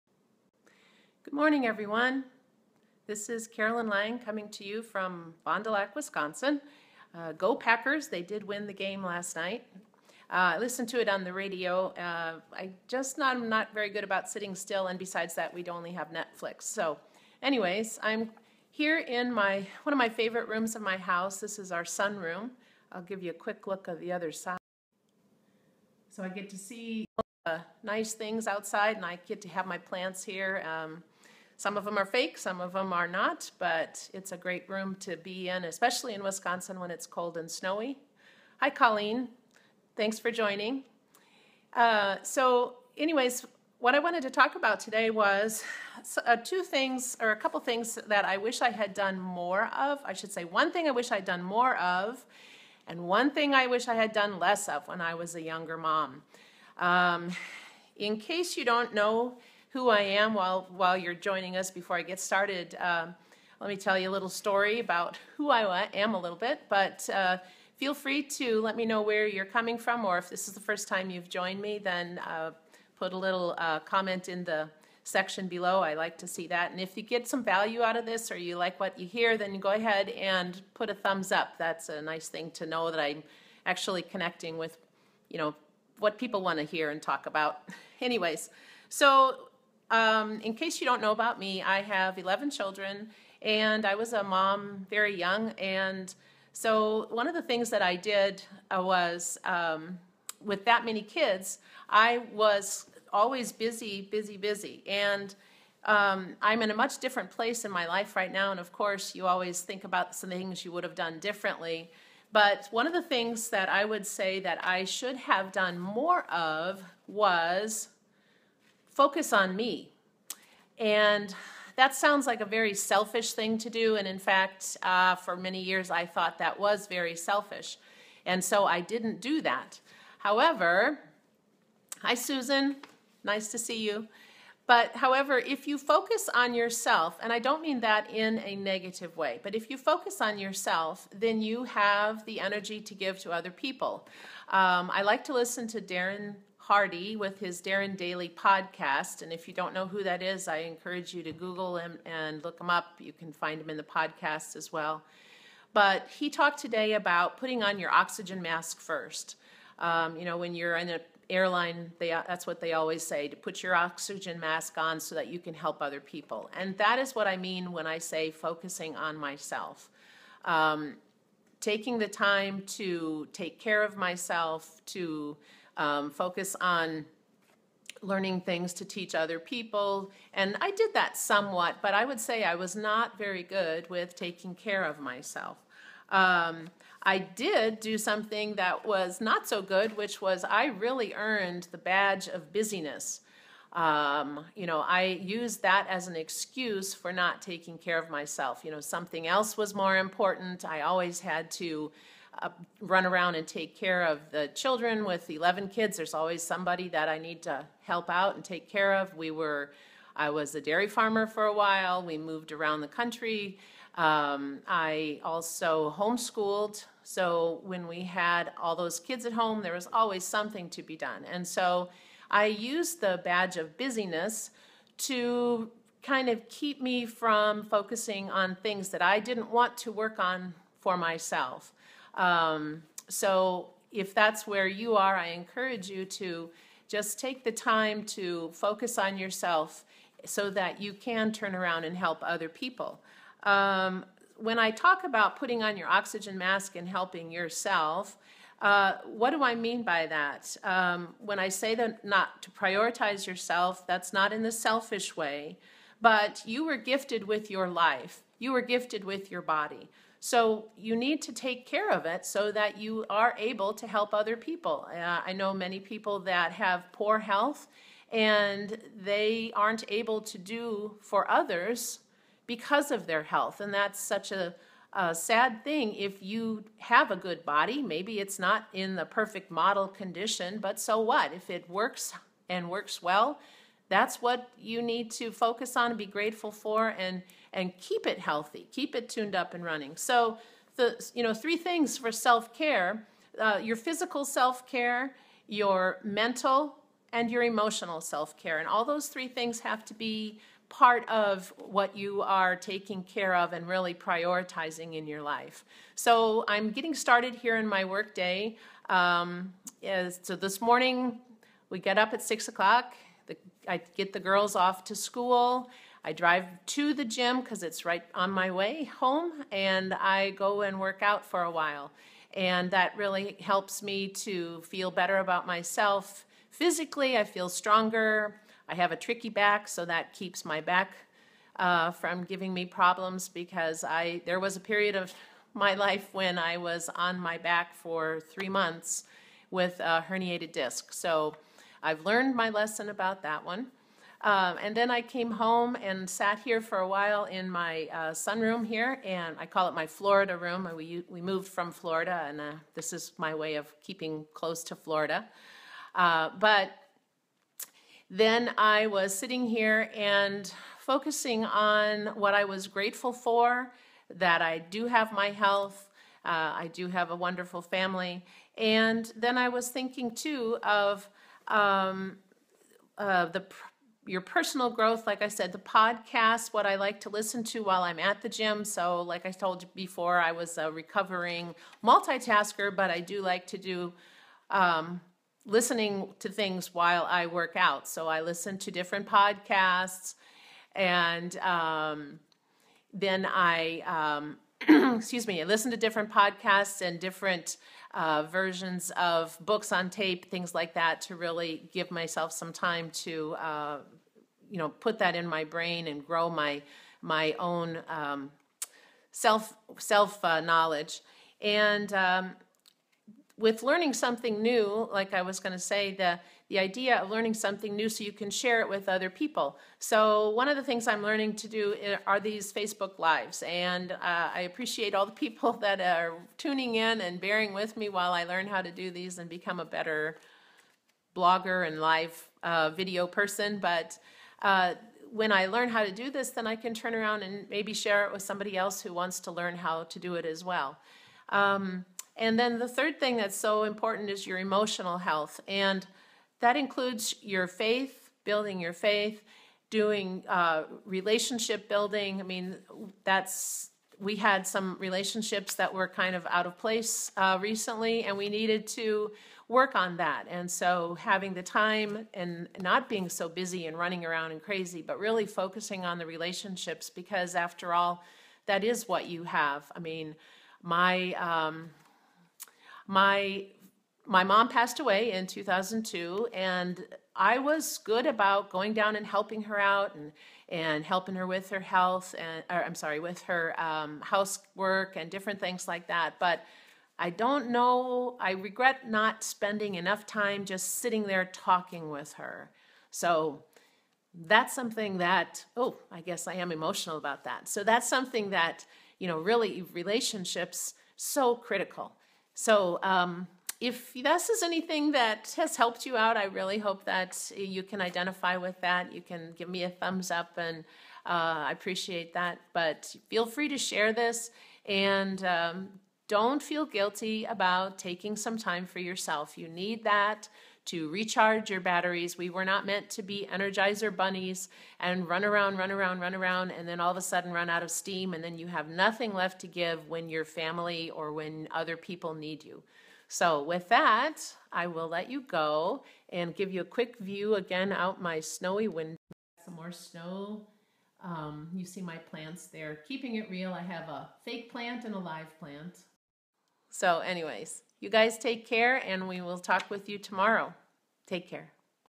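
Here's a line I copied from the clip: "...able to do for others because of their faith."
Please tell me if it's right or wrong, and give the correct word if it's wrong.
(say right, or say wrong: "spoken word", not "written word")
wrong: "health", not "faith".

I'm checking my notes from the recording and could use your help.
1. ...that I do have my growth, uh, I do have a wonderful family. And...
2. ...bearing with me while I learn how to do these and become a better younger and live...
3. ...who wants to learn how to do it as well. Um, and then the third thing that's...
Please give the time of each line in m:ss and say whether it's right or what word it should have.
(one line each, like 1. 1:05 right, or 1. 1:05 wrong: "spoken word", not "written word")
1. 6:04 wrong: "health", not "growth"
2. 7:07 wrong: "blogger", not "younger"
3. 7:18 right.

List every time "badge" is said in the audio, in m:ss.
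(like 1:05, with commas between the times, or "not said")
3:11, 3:43.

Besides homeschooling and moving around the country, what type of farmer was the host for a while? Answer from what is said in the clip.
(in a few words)
Dairy farmer.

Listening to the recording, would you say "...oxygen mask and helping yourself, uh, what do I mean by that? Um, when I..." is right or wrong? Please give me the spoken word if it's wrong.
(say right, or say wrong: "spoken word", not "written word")
right.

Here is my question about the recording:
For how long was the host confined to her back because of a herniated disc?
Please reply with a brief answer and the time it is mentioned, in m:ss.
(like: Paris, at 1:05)
3 months, at 5:38.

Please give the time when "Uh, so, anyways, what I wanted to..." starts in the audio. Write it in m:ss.
0:41.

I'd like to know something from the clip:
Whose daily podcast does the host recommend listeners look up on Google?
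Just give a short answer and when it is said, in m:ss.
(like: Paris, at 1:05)
Darren Hardy, at 2:25.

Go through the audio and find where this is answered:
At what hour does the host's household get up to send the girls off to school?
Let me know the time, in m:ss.
5:12.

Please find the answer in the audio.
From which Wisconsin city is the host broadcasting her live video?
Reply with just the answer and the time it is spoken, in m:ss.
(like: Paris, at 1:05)
Fond du Lac, at 0:05.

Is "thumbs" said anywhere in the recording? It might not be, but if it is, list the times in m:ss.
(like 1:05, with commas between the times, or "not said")
1:20, 8:29.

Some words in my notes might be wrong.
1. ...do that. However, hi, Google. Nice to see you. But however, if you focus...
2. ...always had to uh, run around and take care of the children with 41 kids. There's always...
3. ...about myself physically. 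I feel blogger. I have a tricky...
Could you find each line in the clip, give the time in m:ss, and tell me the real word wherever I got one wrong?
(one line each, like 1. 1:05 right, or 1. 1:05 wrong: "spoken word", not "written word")
1. 2:09 wrong: "Susan", not "Google"
2. 3:20 wrong: "11", not "41"
3. 5:25 wrong: "stronger", not "blogger".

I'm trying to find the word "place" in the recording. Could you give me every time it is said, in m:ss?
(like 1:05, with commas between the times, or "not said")
1:47, 7:36.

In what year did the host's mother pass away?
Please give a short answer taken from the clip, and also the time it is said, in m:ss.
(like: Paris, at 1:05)
2002, at 7:55.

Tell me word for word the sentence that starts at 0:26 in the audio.
So I get to see uh, nice things outside, and I get to have my plants here.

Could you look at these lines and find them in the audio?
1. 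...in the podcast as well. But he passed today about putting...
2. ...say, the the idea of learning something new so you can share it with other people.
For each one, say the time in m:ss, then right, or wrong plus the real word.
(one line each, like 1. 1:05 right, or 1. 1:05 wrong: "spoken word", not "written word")
1. 2:33 wrong: "talked", not "passed"
2. 6:55 right.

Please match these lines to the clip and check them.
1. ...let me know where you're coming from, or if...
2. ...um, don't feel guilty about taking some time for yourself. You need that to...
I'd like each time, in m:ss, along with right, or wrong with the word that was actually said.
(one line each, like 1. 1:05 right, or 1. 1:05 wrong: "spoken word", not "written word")
1. 1:08 right
2. 8:35 right.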